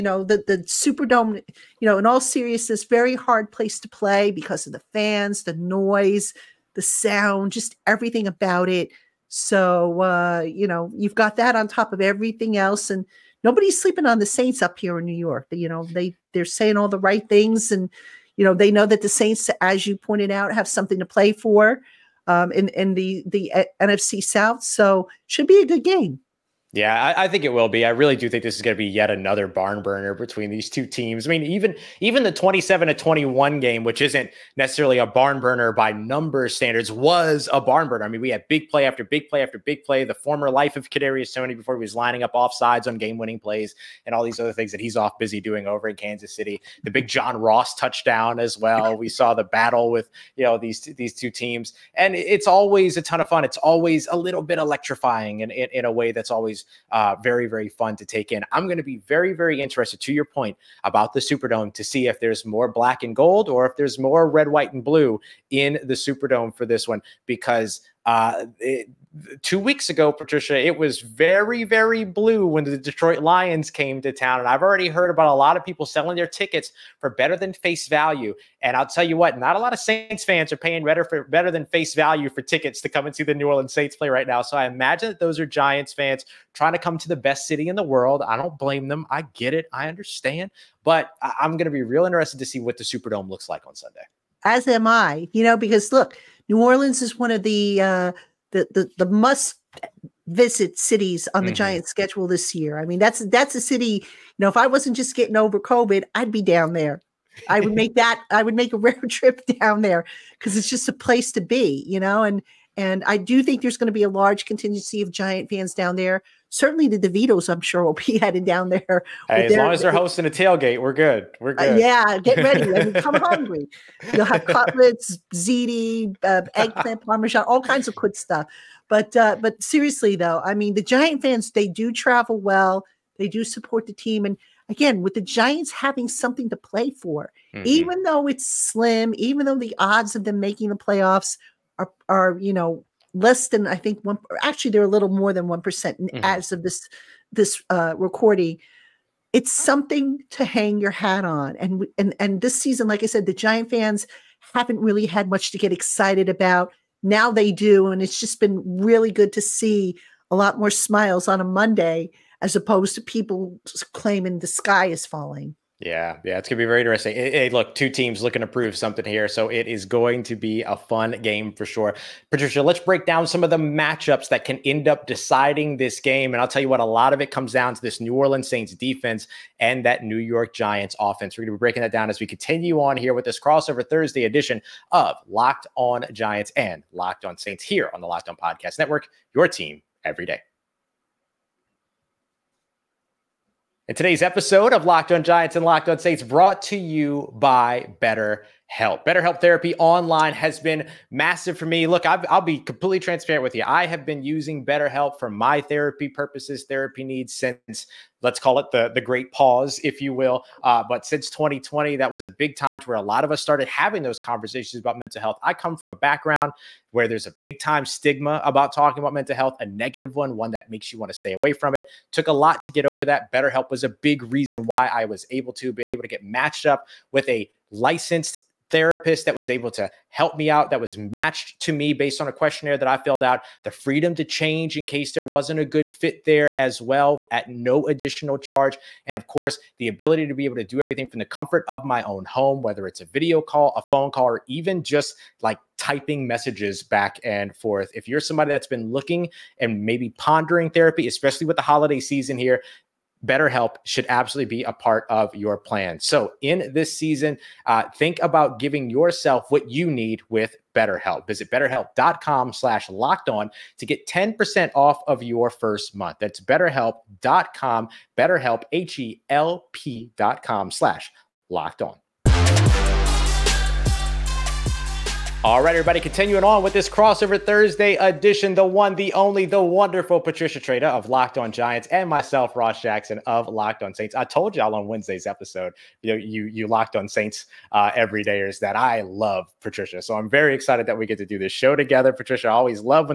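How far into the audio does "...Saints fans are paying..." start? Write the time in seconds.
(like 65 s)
79 s.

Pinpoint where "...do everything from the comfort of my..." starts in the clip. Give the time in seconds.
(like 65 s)
240 s.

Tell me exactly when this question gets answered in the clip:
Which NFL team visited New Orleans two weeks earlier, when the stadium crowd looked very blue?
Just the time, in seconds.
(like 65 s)
72 s.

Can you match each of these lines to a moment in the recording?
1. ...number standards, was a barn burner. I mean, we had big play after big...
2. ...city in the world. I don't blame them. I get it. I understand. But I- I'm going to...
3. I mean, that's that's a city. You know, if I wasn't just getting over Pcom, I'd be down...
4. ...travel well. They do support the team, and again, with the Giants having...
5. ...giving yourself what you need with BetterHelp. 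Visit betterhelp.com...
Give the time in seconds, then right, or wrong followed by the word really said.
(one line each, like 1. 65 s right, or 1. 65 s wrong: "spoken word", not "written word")
1. 35 s right
2. 87 s right
3. 102 s wrong: "COVID", not "Pcom"
4. 131 s right
5. 258 s right.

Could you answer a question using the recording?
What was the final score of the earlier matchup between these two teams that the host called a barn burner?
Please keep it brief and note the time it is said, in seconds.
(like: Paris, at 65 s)
27 to 21, at 32 s.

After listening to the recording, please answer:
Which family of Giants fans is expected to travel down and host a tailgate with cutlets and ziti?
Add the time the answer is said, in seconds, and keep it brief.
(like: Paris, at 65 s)
The DeVitos, at 116 s.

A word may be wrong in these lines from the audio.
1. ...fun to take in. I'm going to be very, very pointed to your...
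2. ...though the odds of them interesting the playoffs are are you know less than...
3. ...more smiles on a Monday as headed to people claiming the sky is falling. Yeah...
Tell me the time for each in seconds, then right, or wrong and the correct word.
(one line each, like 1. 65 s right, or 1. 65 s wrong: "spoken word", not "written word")
1. 57 s wrong: "interested", not "pointed"
2. 139 s wrong: "making", not "interesting"
3. 160 s wrong: "opposed", not "headed".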